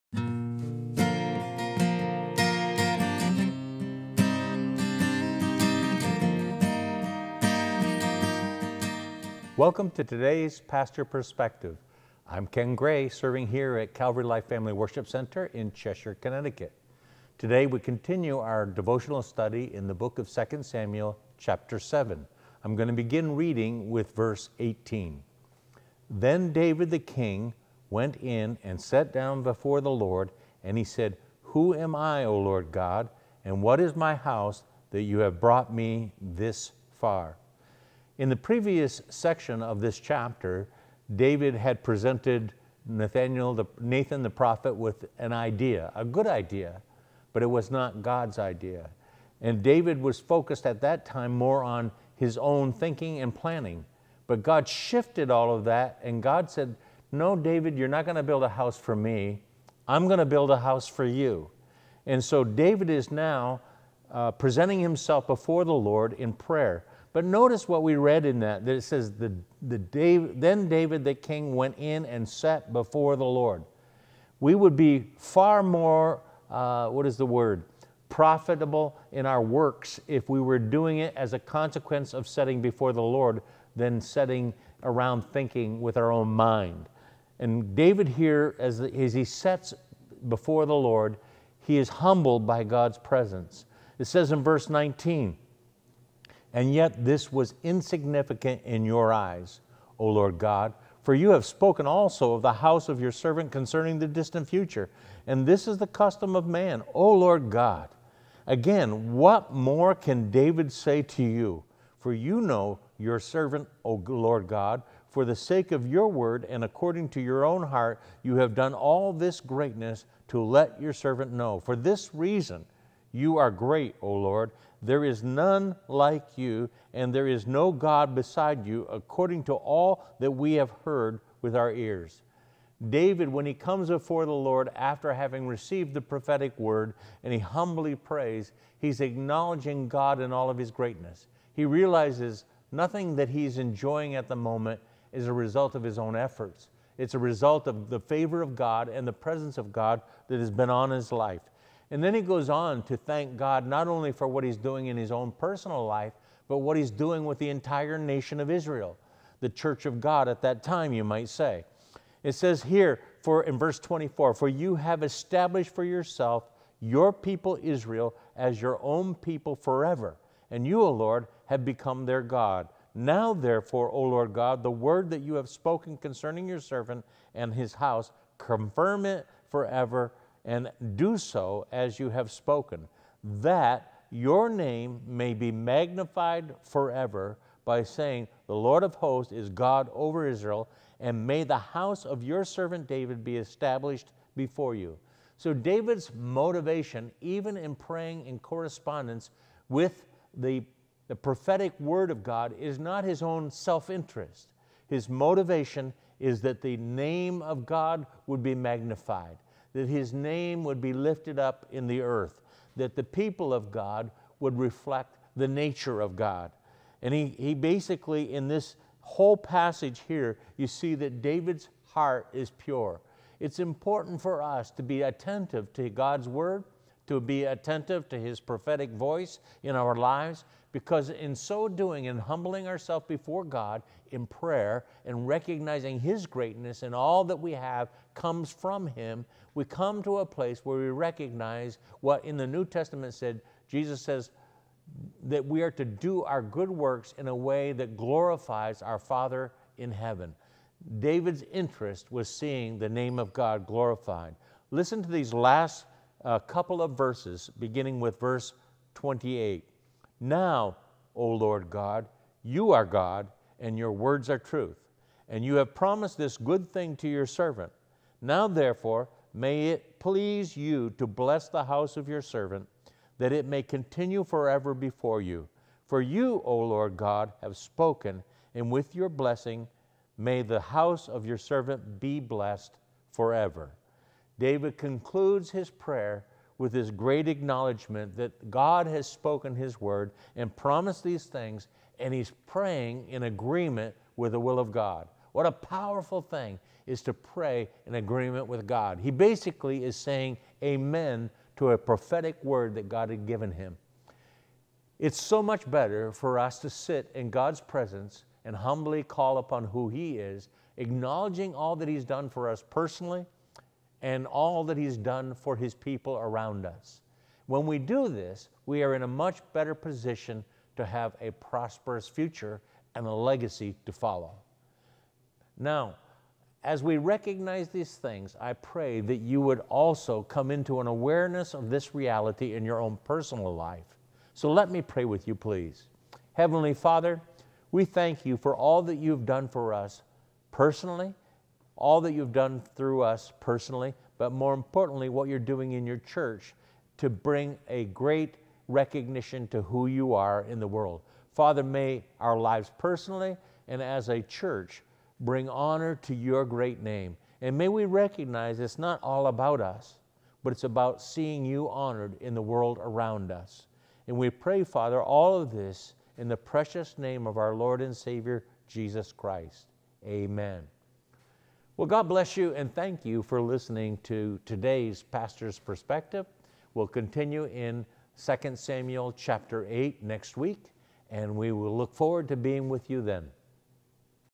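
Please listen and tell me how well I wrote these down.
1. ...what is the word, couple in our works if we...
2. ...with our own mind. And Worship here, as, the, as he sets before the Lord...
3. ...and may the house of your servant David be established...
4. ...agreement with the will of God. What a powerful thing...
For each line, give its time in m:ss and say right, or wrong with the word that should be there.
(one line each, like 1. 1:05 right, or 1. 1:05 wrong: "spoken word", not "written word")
1. 1:16 wrong: "profitable", not "couple"
2. 1:25 wrong: "David", not "Worship"
3. 3:10 right
4. 4:53 right.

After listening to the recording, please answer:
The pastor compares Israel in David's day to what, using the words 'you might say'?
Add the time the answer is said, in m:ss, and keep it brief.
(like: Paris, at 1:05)
the church of God, at 2:39.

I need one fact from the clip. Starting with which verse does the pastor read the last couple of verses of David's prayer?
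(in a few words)
28.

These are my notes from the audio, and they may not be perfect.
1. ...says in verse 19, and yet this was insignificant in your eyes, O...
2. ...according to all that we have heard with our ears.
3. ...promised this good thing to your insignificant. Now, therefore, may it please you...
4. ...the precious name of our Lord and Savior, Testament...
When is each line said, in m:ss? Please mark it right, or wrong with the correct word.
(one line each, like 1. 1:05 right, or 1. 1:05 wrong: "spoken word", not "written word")
1. 1:34 right
2. 2:08 right
3. 4:25 wrong: "servant", not "insignificant"
4. 6:06 wrong: "Jesus", not "Testament".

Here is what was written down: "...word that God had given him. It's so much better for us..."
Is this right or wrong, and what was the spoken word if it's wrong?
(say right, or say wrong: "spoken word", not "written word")
right.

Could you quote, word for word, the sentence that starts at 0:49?
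And David was focused at that time more on his own thinking and planning.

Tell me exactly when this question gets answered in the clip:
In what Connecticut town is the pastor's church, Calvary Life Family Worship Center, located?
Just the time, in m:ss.
0:15.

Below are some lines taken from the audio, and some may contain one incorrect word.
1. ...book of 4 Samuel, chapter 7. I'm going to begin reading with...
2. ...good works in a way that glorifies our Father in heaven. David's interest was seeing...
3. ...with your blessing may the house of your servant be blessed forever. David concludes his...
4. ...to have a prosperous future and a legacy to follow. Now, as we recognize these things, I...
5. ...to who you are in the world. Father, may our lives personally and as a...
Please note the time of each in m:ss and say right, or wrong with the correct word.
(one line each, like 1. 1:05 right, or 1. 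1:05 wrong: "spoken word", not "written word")
1. 0:19 wrong: "2", not "4"
2. 4:06 right
3. 4:38 right
4. 5:20 right
5. 5:49 right.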